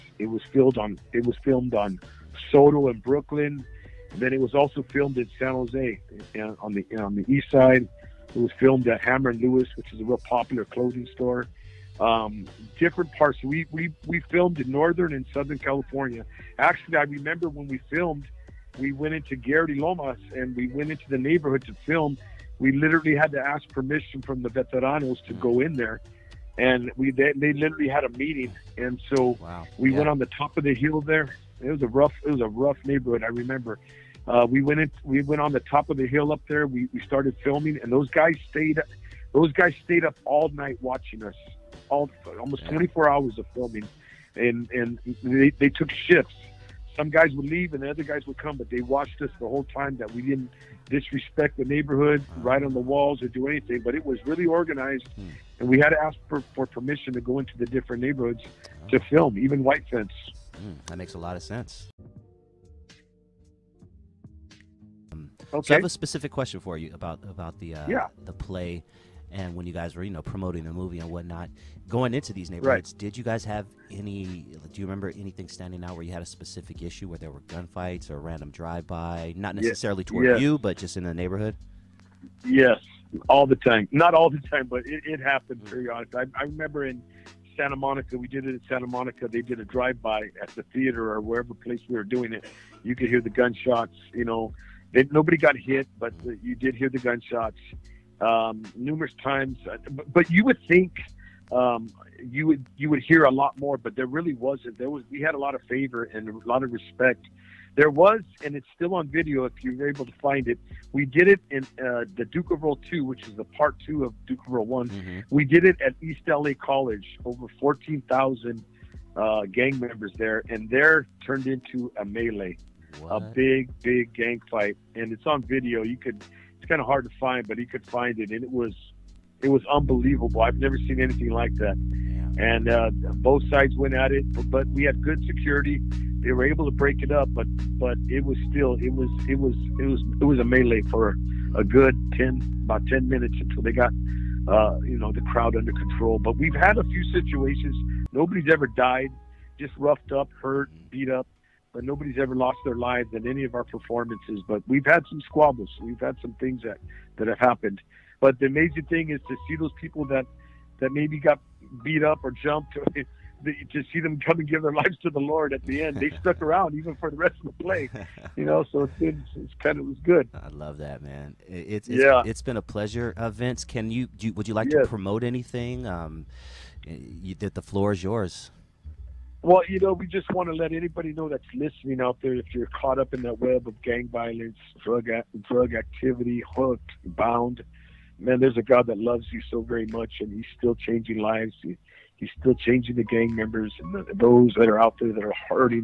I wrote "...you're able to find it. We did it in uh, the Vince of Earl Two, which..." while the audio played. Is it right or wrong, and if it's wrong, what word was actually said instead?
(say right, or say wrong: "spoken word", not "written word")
wrong: "Duke", not "Vince".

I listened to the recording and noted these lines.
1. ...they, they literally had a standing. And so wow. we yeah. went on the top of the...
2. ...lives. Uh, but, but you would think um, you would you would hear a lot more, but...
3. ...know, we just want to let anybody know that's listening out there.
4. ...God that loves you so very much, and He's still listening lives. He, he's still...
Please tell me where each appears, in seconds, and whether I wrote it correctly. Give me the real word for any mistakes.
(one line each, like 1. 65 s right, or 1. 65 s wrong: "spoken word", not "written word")
1. 27 s wrong: "meeting", not "standing"
2. 99 s wrong: "times", not "lives"
3. 179 s right
4. 188 s wrong: "changing", not "listening".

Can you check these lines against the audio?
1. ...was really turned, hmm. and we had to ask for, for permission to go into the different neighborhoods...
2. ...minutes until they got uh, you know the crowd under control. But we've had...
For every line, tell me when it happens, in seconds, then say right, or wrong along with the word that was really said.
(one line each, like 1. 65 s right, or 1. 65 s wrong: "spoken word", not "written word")
1. 54 s wrong: "organized", not "turned"
2. 143 s right.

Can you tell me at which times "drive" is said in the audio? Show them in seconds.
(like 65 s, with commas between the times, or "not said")
78 s, 89 s.